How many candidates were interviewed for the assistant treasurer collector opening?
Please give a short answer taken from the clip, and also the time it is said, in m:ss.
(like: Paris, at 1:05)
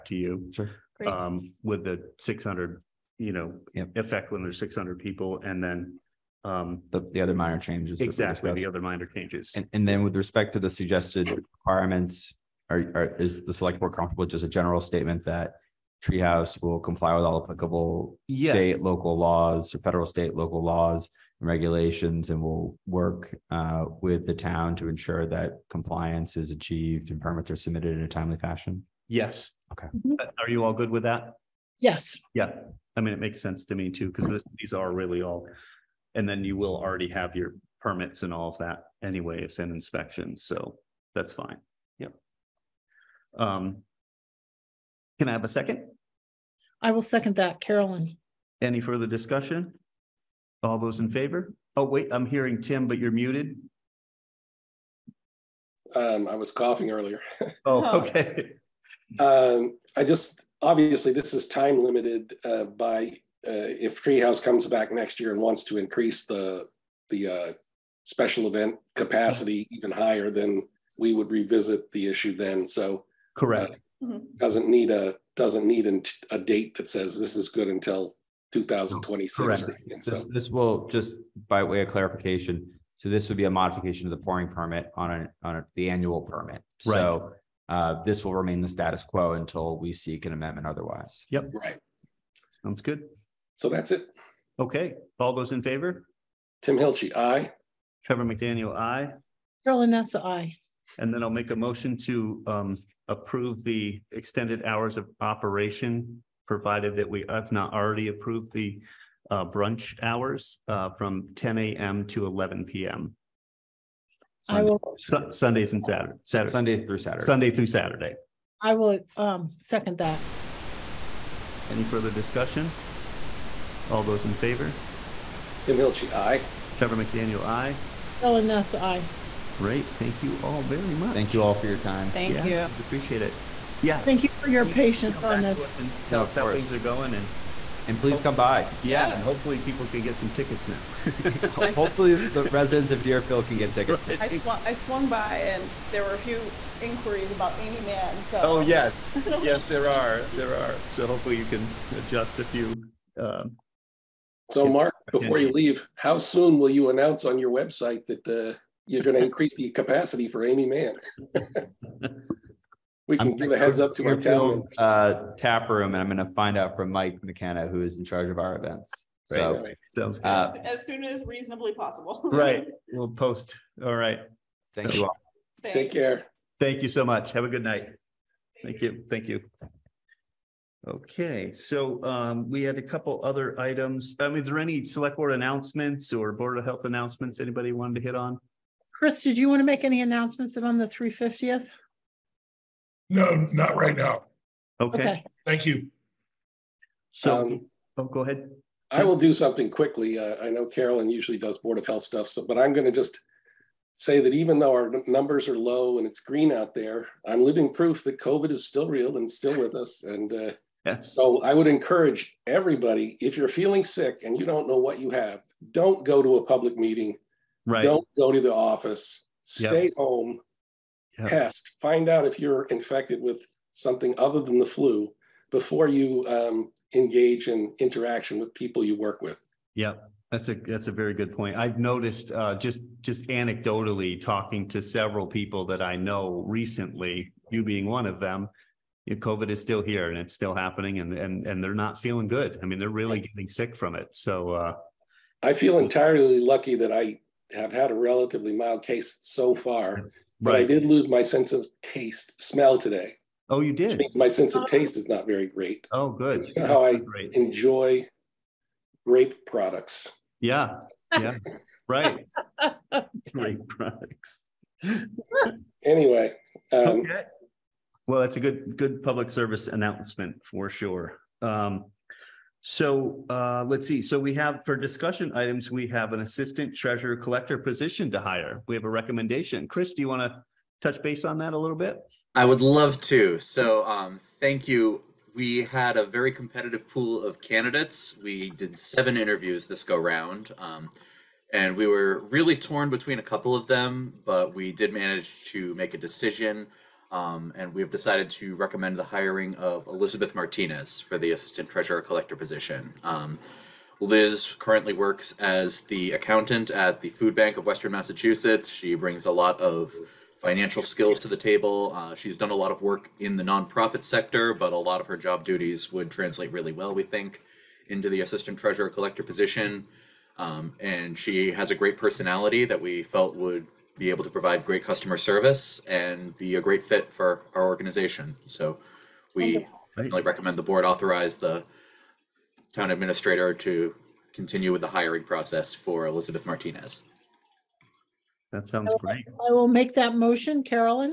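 7, at 4:48.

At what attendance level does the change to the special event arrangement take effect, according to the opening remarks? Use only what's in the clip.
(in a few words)
600 people.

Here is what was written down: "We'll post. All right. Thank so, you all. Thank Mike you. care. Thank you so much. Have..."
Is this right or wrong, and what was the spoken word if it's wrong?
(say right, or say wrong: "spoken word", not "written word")
wrong: "Take", not "Mike".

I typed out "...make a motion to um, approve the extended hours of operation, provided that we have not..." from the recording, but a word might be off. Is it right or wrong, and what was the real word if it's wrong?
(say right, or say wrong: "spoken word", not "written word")
right.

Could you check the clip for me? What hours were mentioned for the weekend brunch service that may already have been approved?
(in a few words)
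10 AM to 11 PM.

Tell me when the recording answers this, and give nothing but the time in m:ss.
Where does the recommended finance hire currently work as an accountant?
5:07.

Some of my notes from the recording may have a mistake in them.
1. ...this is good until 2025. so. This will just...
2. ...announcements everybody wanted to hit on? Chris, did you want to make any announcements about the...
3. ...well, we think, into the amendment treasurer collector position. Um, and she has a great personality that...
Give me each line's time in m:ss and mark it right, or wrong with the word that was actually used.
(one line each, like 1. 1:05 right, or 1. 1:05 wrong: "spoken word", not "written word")
1. 1:17 wrong: "2026", not "2025"
2. 3:06 wrong: "anybody", not "everybody"
3. 5:16 wrong: "assistant", not "amendment".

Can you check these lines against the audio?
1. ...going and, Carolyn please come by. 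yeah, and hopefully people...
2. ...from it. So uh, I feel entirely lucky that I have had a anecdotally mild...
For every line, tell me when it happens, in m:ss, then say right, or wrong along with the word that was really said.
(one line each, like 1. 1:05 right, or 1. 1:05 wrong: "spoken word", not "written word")
1. 2:16 wrong: "And", not "Carolyn"
2. 4:03 wrong: "relatively", not "anecdotally".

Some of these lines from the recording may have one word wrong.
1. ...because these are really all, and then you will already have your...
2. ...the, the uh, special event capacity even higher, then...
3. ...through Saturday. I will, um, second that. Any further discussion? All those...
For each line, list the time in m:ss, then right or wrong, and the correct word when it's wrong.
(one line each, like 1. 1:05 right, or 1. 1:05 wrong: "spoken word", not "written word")
1. 0:34 right
2. 1:06 right
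3. 1:57 right.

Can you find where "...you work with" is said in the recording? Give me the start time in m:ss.
3:48.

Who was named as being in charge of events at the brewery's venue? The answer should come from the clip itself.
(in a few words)
Mike McKenna.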